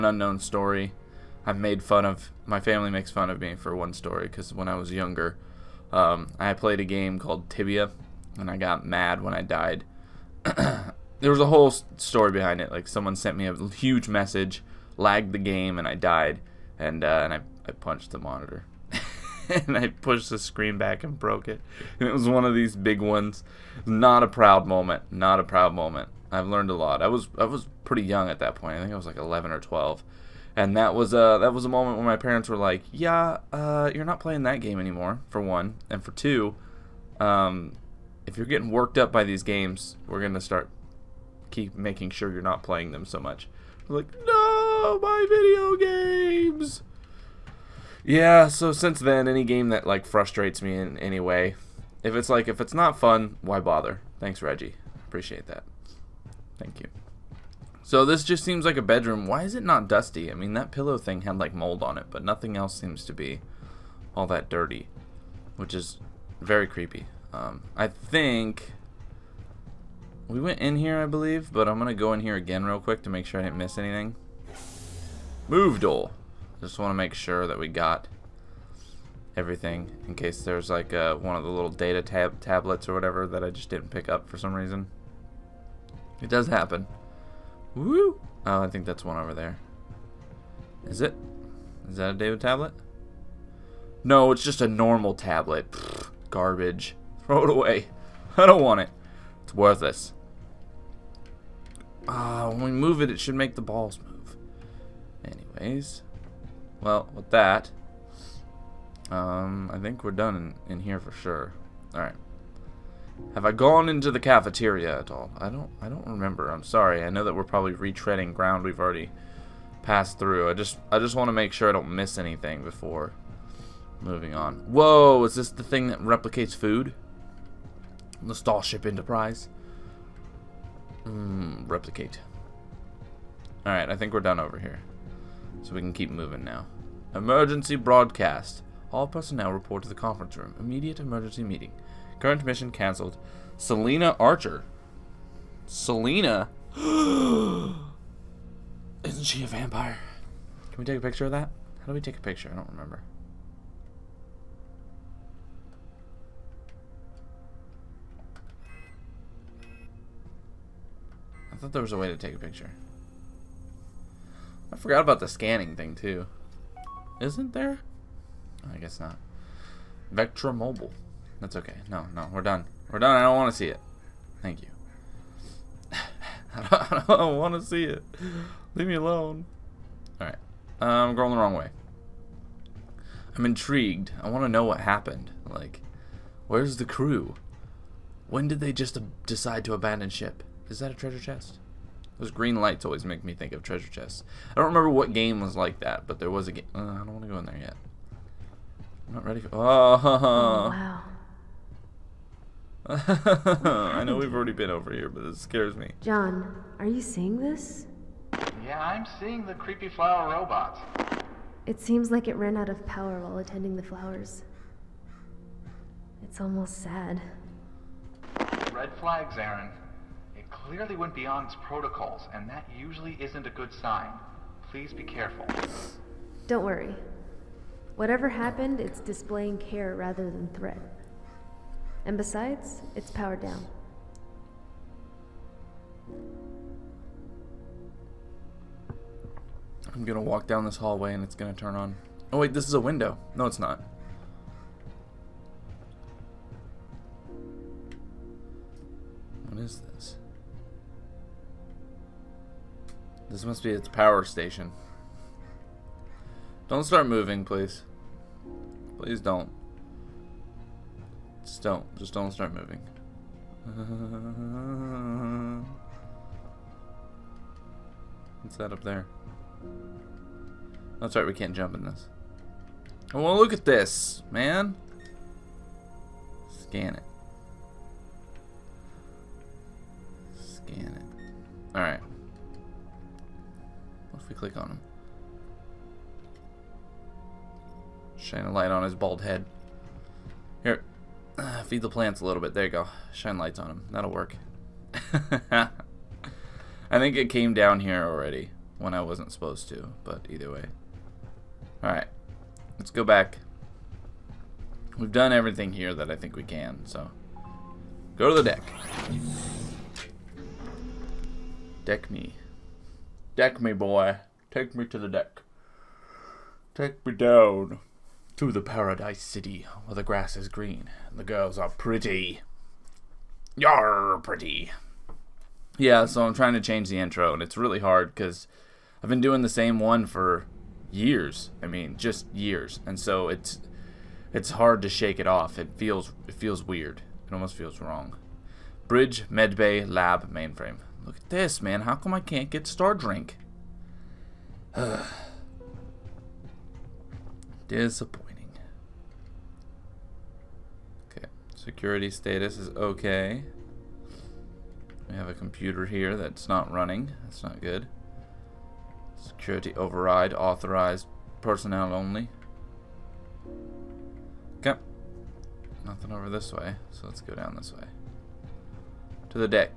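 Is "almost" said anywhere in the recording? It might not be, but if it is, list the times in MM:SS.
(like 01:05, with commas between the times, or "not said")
03:36, 05:37.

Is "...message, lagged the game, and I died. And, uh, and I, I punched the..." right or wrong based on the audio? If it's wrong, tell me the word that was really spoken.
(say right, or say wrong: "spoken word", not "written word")
right.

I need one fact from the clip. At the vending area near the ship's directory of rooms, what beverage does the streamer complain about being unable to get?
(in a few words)
Star Drink.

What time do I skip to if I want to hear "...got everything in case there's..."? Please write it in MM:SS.
01:17.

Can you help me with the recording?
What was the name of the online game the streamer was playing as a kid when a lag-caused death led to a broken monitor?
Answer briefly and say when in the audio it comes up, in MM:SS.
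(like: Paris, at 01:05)
Tibia, at 00:07.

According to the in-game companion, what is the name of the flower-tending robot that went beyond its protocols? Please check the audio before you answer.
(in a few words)
Aryn.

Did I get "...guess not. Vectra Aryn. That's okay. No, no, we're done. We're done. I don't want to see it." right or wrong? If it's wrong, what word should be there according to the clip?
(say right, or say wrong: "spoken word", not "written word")
wrong: "Mobile", not "Aryn".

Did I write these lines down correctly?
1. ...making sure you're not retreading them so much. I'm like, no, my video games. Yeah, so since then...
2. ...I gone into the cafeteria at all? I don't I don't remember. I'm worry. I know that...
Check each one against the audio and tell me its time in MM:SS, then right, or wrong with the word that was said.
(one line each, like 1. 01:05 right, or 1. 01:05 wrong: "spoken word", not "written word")
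1. 00:41 wrong: "playing", not "retreading"
2. 01:53 wrong: "sorry", not "worry".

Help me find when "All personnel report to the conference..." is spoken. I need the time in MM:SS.
02:18.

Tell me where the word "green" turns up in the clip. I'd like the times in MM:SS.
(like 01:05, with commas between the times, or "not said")
03:12, 05:20.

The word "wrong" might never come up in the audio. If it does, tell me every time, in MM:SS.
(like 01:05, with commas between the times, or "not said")
03:01, 05:37.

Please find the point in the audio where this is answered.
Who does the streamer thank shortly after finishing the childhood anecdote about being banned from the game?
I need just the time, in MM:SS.
00:54.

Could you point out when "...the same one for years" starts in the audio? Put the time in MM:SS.
05:29.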